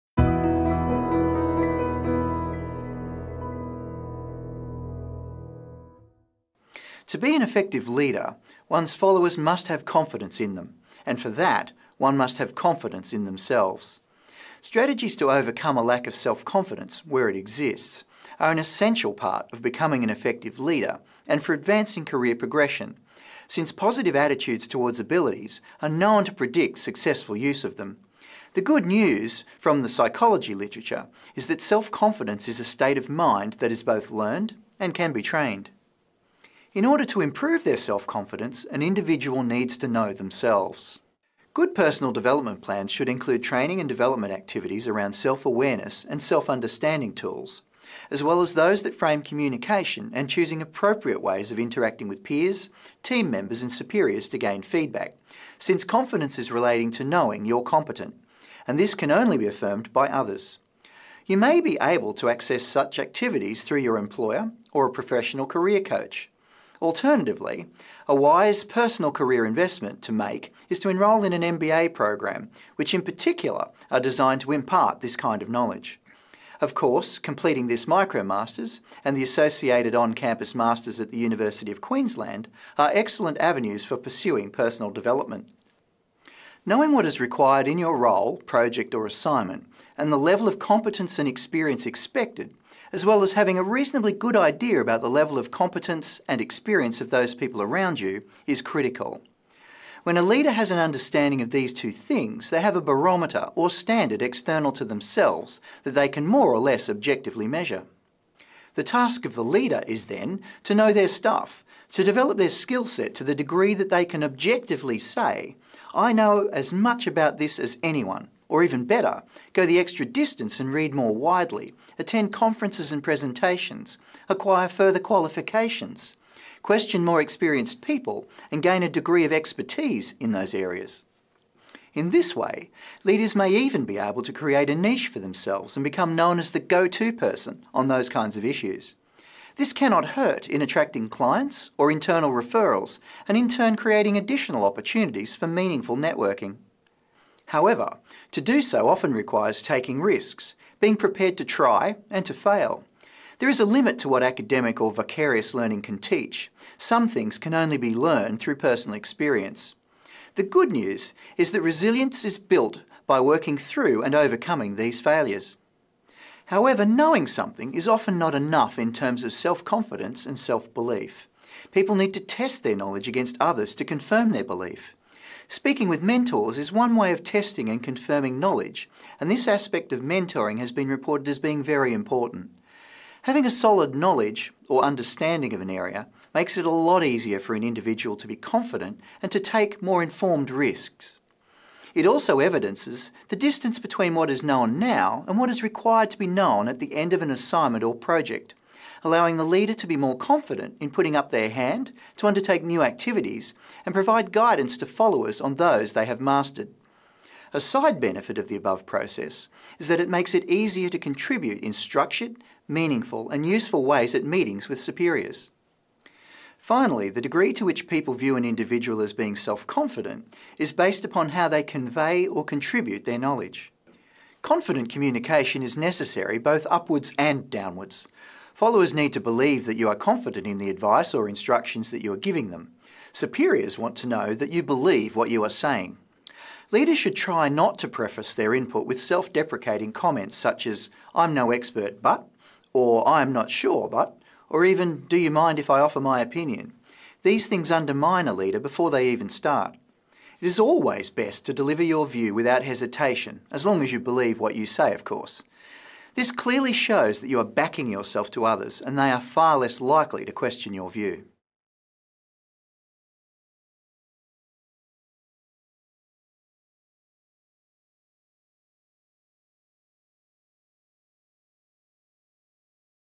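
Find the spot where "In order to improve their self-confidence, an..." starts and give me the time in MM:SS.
00:36.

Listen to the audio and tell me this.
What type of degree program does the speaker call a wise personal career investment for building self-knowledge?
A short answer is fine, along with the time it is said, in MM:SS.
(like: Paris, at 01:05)
MBA, at 01:11.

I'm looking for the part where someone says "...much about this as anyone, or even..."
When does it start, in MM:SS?
01:56.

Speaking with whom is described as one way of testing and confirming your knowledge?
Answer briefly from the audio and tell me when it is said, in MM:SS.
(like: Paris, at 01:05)
Mentors, at 02:56.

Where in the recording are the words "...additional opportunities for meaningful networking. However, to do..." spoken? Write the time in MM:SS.
02:24.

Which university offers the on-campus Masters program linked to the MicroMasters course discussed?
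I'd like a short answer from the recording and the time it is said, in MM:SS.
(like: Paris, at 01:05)
University of Queensland, at 01:21.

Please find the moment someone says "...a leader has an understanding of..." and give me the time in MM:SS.
01:40.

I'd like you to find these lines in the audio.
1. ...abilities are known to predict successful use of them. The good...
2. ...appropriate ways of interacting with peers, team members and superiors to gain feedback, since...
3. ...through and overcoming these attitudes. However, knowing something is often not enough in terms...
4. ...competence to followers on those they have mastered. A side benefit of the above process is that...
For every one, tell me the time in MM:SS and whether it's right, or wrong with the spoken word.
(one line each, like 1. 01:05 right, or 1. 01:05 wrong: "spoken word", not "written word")
1. 00:24 right
2. 00:50 right
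3. 02:43 wrong: "failures", not "attitudes"
4. 03:24 wrong: "guidance", not "competence".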